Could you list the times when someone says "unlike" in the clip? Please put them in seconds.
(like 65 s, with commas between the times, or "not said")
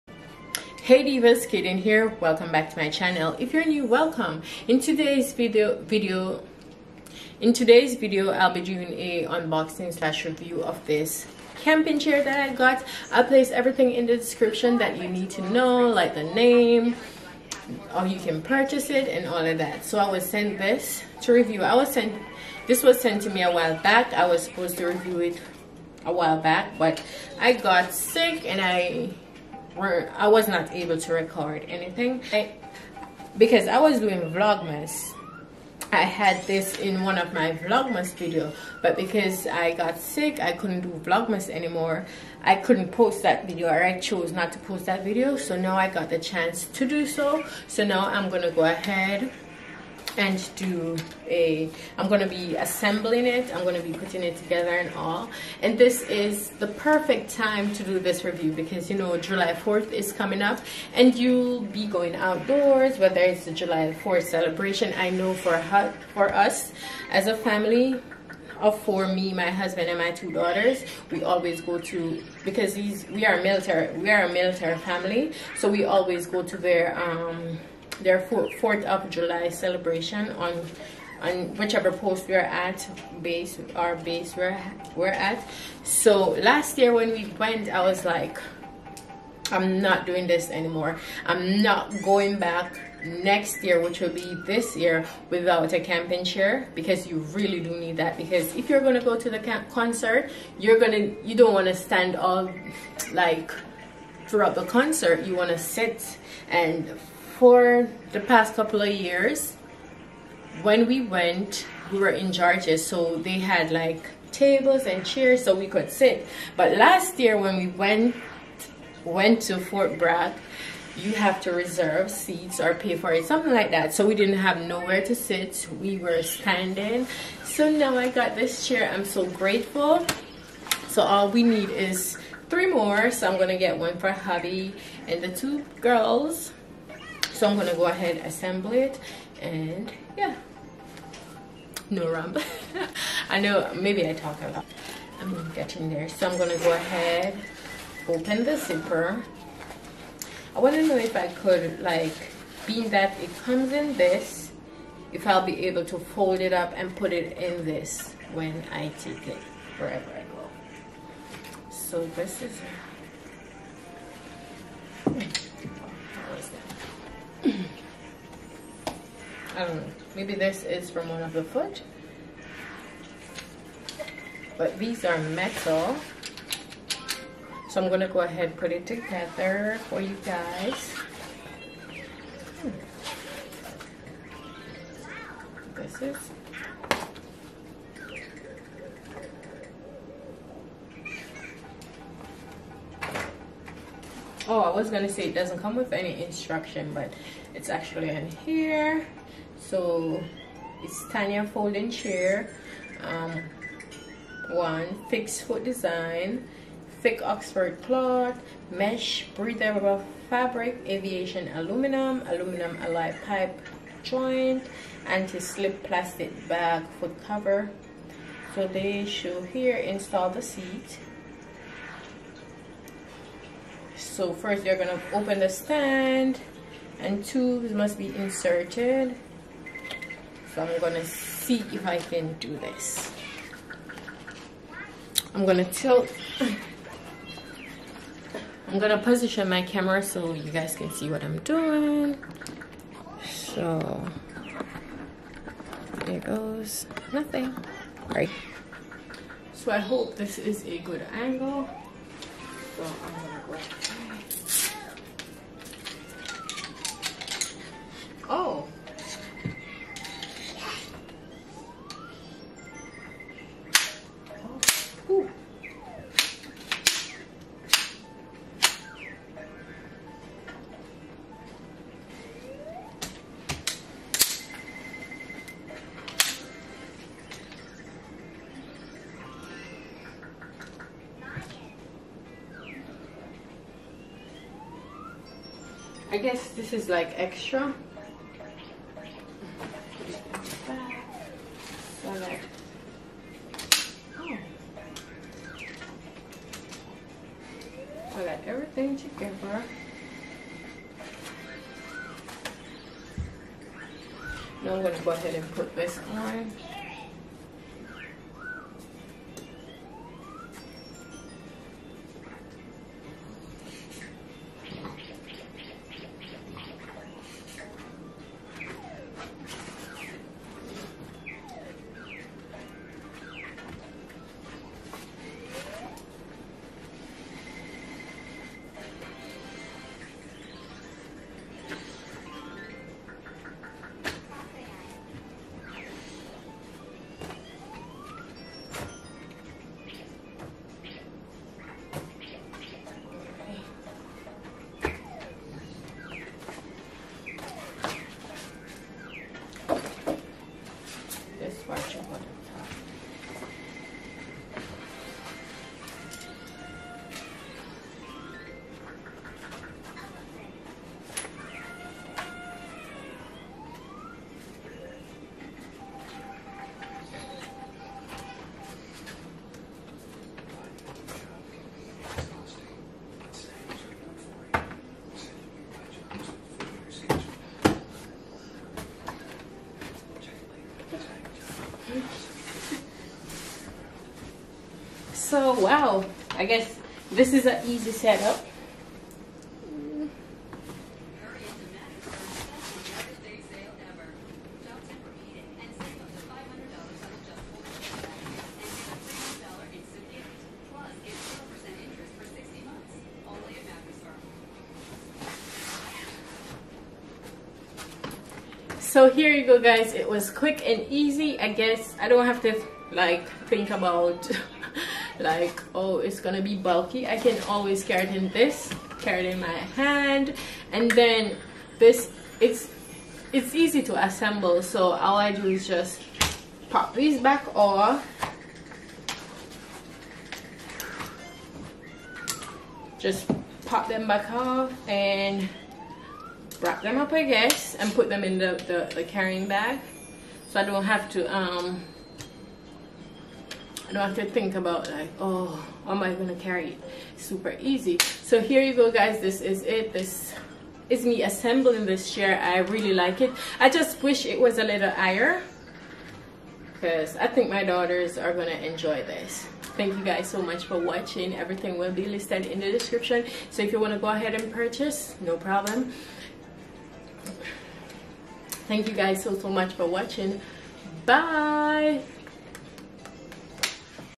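not said.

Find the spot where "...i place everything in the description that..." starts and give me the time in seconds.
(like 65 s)
13 s.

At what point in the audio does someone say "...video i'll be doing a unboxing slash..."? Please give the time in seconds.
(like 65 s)
7 s.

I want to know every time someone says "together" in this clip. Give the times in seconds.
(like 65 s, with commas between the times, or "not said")
54 s, 178 s, 298 s.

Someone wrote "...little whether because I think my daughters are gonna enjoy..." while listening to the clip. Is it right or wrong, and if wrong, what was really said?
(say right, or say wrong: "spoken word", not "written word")
wrong: "higher", not "whether".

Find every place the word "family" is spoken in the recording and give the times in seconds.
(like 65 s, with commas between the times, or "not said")
67 s, 74 s.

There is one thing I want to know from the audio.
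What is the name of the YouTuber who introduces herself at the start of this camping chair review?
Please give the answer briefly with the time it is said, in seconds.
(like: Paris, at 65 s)
Kaden, at 1 s.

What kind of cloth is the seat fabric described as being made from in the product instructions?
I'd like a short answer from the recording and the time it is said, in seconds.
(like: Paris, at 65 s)
Oxford cloth, at 207 s.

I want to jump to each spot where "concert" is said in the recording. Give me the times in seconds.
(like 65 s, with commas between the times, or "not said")
99 s, 104 s.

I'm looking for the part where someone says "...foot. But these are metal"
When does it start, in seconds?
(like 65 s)
171 s.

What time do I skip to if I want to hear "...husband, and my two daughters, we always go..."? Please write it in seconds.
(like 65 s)
69 s.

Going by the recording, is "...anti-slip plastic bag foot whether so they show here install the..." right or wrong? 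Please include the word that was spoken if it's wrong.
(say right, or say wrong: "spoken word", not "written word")
wrong: "cover", not "whether".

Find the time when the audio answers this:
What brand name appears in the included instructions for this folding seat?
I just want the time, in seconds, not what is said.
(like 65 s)
201 s.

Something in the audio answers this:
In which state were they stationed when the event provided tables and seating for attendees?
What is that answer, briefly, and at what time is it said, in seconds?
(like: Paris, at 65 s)
Georgia, at 112 s.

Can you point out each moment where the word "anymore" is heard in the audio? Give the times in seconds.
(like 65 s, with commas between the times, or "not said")
41 s, 90 s.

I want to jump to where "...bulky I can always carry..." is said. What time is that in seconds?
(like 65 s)
416 s.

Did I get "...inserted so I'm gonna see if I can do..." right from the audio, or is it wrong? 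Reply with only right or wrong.
right.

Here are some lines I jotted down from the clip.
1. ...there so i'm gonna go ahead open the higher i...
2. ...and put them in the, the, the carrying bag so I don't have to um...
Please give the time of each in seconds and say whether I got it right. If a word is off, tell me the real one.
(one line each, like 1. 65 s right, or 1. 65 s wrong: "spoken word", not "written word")
1. 145 s wrong: "zipper", not "higher"
2. 437 s right.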